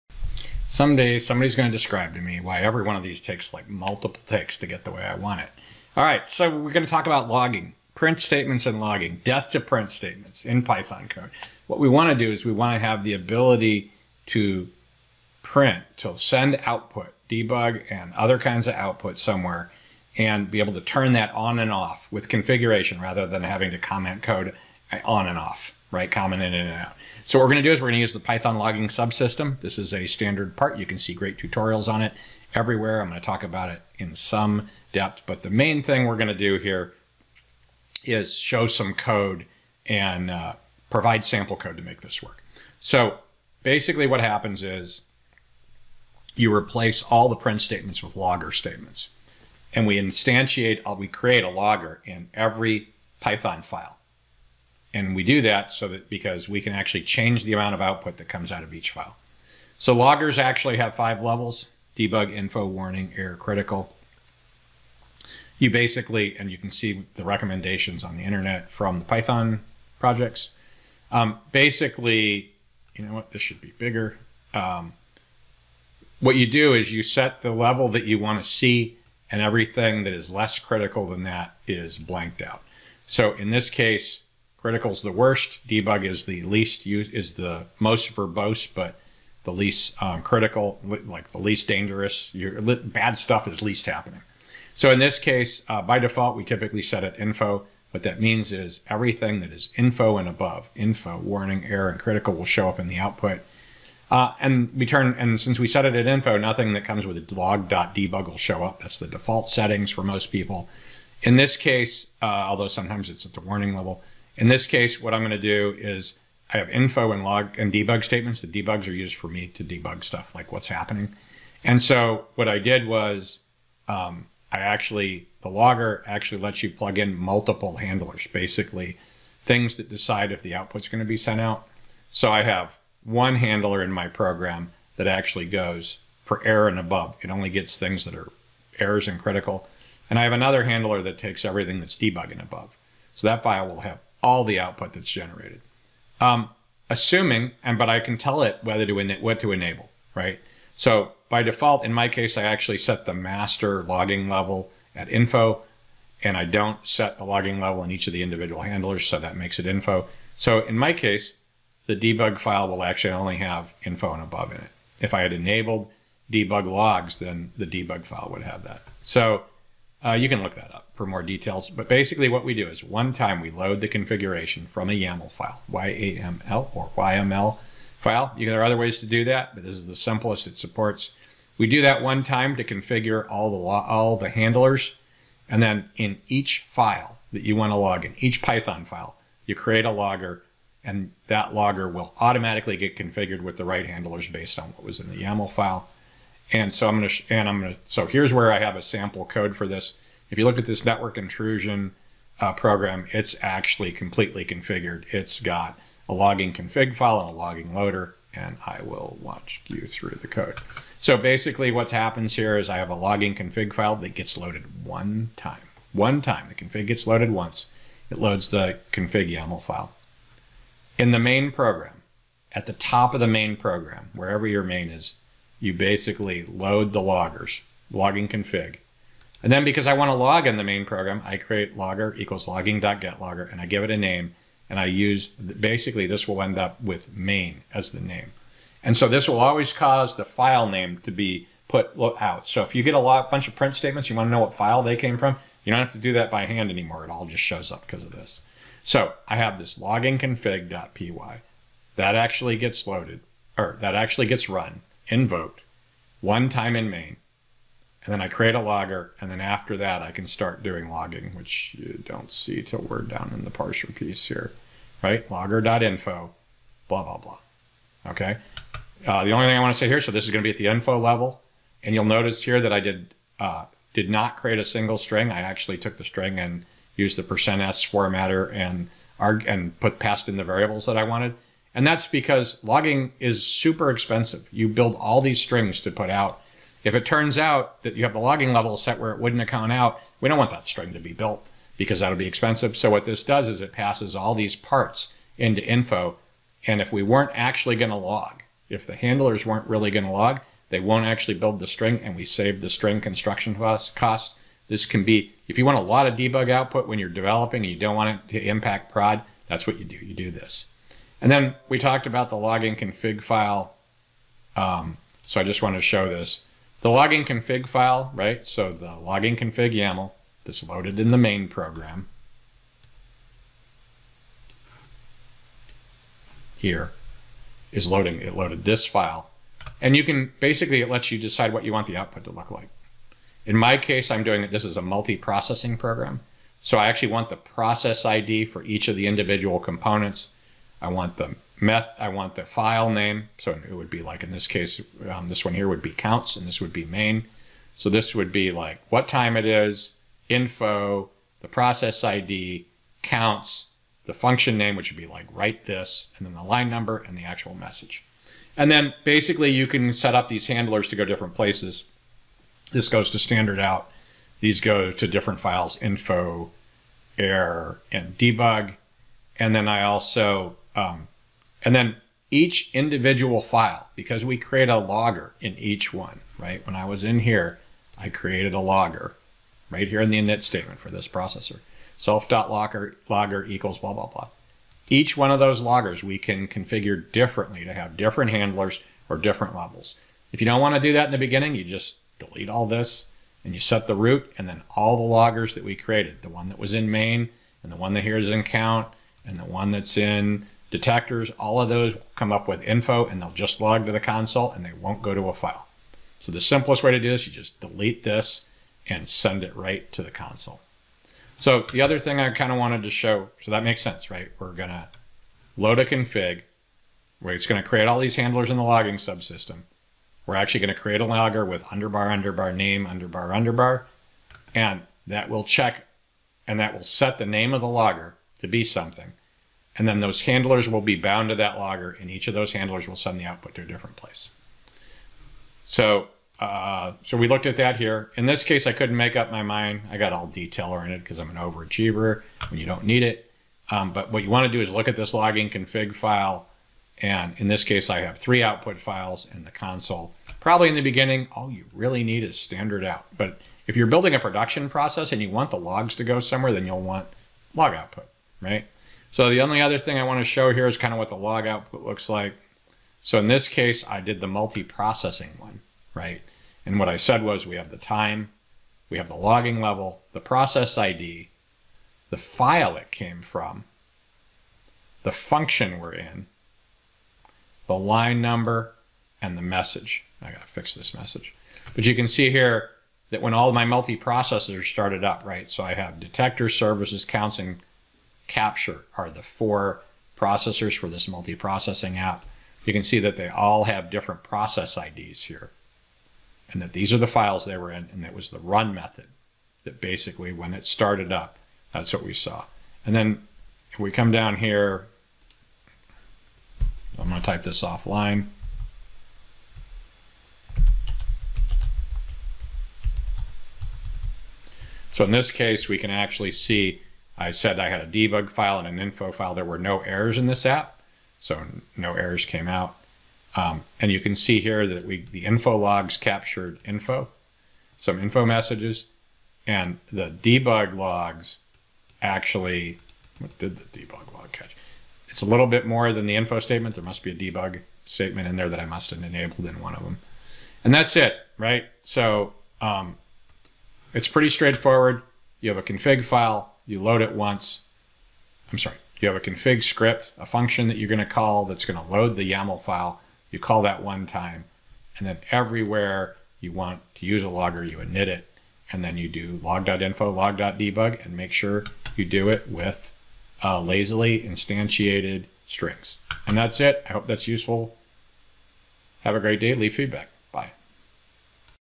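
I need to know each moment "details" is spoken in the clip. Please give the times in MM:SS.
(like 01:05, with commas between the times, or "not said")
02:51, 07:20.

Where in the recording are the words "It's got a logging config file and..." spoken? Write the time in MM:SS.
03:25.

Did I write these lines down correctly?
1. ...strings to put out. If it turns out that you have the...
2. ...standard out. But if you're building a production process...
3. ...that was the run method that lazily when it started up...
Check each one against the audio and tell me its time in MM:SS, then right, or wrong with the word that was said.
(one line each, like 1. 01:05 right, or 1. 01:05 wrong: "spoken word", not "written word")
1. 04:45 right
2. 07:32 right
3. 08:18 wrong: "basically", not "lazily".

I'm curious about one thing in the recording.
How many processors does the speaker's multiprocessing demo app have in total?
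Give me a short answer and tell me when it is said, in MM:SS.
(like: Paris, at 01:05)
4, at 08:09.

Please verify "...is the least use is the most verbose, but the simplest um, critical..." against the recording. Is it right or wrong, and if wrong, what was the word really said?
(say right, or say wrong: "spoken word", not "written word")
wrong: "least", not "simplest".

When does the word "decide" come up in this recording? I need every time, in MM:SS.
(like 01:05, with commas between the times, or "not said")
02:09, 05:31.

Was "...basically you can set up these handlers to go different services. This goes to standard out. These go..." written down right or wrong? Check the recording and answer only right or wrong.
wrong.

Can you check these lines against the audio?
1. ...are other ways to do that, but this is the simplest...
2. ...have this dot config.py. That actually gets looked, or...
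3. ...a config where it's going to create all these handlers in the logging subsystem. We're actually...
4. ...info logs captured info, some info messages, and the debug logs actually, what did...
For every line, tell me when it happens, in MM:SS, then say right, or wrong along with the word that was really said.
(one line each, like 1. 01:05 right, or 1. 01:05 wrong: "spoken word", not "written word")
1. 02:58 right
2. 04:09 wrong: "loaded", not "looked"
3. 06:55 right
4. 08:45 right.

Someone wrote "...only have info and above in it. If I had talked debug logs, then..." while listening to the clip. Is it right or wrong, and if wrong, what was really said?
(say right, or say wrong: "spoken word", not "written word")
wrong: "enabled", not "talked".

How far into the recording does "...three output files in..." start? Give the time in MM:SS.
07:28.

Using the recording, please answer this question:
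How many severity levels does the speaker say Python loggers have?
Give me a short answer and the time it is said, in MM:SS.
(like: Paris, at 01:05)
5, at 01:00.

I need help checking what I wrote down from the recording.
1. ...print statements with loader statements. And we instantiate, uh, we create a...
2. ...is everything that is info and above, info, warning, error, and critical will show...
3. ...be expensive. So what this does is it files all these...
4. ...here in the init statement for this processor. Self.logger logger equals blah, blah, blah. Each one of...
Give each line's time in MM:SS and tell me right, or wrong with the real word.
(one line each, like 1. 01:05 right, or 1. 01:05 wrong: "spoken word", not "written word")
1. 00:47 wrong: "logger", not "loader"
2. 01:38 right
3. 04:52 wrong: "passes", not "files"
4. 06:19 right.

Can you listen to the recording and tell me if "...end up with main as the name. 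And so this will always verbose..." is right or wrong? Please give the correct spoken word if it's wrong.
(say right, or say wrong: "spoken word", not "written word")
wrong: "cause", not "verbose".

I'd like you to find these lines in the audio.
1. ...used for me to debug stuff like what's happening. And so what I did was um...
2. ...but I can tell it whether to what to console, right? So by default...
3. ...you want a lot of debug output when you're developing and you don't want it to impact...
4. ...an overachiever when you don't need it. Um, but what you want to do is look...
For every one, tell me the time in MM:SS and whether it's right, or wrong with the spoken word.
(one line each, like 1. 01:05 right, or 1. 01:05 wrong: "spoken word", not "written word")
1. 01:58 right
2. 02:27 wrong: "enable", not "console"
3. 05:05 right
4. 07:21 right.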